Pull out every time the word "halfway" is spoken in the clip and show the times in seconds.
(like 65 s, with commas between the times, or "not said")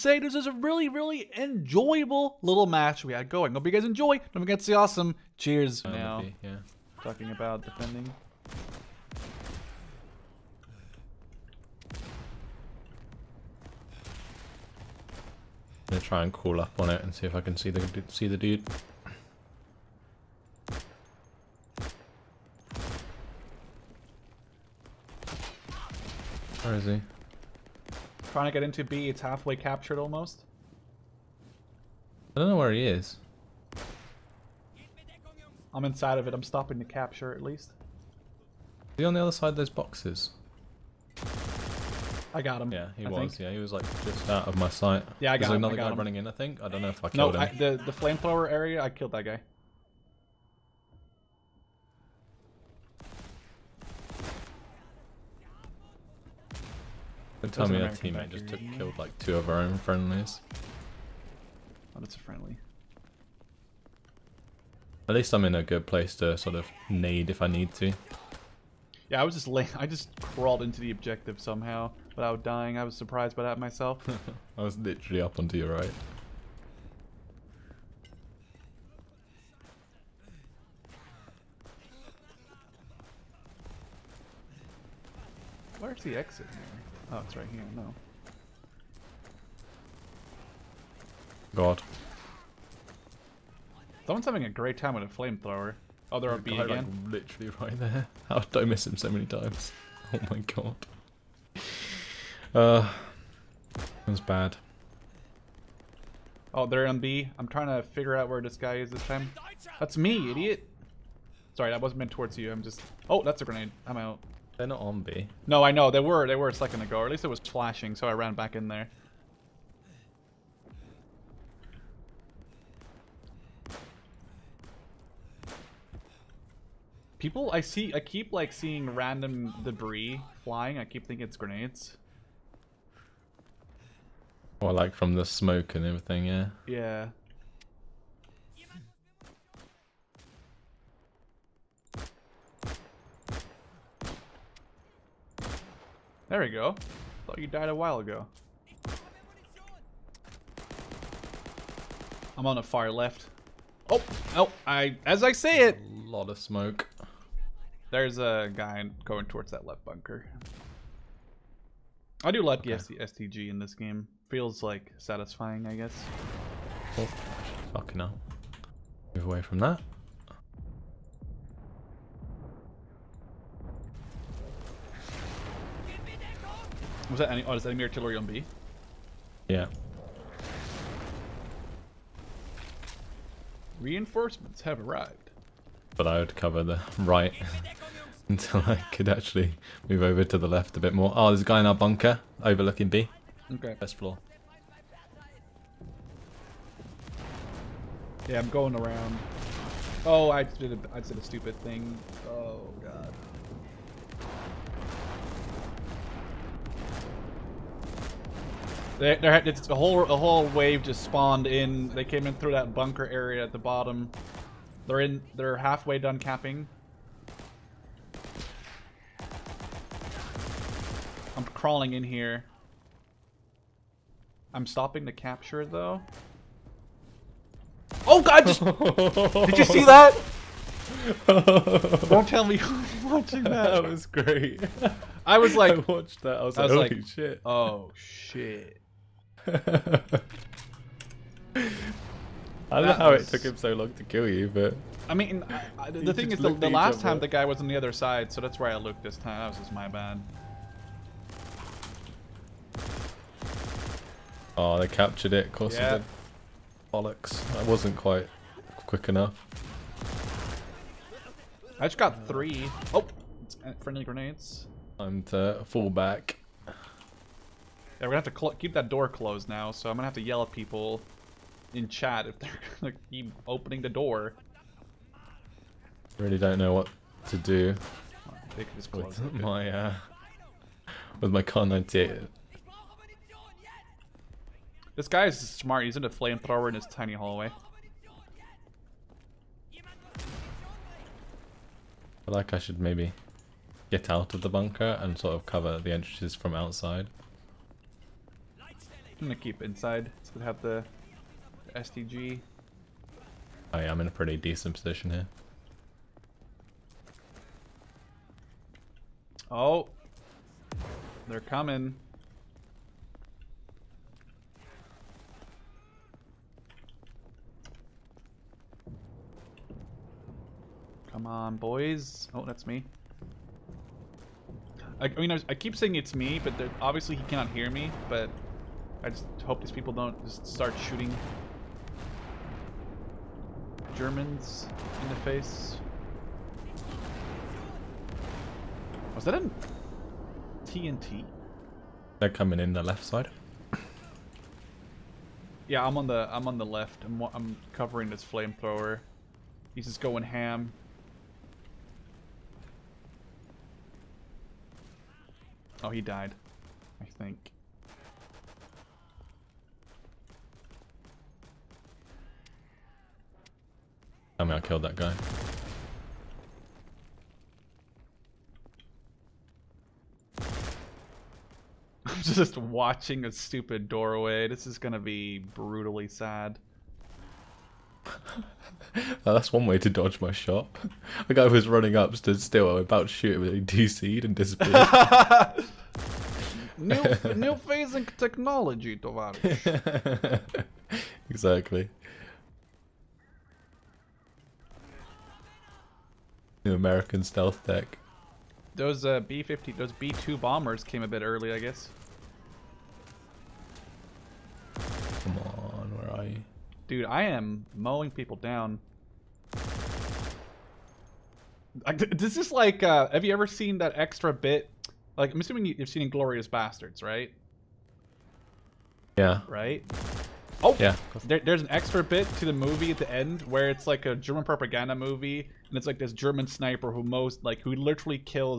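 29 s, 215 s.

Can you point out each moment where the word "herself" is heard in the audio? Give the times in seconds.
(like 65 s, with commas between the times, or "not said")
not said.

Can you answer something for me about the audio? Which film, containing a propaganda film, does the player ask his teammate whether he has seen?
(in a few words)
Glorious Bastards.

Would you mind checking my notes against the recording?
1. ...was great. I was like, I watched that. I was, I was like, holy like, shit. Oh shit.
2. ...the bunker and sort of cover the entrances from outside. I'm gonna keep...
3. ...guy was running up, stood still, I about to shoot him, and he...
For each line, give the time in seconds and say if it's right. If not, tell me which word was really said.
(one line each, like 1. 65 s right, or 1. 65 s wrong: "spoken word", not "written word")
1. 233 s right
2. 294 s right
3. 381 s right.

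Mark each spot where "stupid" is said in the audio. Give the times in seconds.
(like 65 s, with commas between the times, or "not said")
201 s, 373 s.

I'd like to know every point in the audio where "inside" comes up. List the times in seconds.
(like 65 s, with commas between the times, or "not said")
35 s, 299 s.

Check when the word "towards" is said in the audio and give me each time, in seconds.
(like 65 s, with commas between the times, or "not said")
112 s, 159 s.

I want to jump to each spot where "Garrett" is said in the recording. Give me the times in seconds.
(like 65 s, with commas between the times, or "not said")
not said.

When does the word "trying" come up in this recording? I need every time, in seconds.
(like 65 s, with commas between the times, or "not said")
28 s, 107 s.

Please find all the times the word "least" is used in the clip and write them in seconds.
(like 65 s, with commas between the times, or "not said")
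37 s, 65 s, 117 s.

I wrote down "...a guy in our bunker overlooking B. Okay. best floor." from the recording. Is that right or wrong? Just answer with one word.
right.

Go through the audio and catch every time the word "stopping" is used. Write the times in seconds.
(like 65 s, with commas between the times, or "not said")
36 s, 224 s.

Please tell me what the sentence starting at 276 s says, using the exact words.
Really don't know what to do.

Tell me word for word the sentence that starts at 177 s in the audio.
Oh, is that enemy artillery on B?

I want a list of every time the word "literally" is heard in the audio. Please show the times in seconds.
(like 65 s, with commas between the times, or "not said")
74 s, 97 s, 427 s.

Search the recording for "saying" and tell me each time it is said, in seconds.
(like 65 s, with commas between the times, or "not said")
325 s.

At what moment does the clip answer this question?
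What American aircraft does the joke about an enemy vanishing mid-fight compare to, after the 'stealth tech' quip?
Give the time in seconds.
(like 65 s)
399 s.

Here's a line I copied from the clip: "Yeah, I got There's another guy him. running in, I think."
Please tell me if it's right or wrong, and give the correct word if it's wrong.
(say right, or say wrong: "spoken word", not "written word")
right.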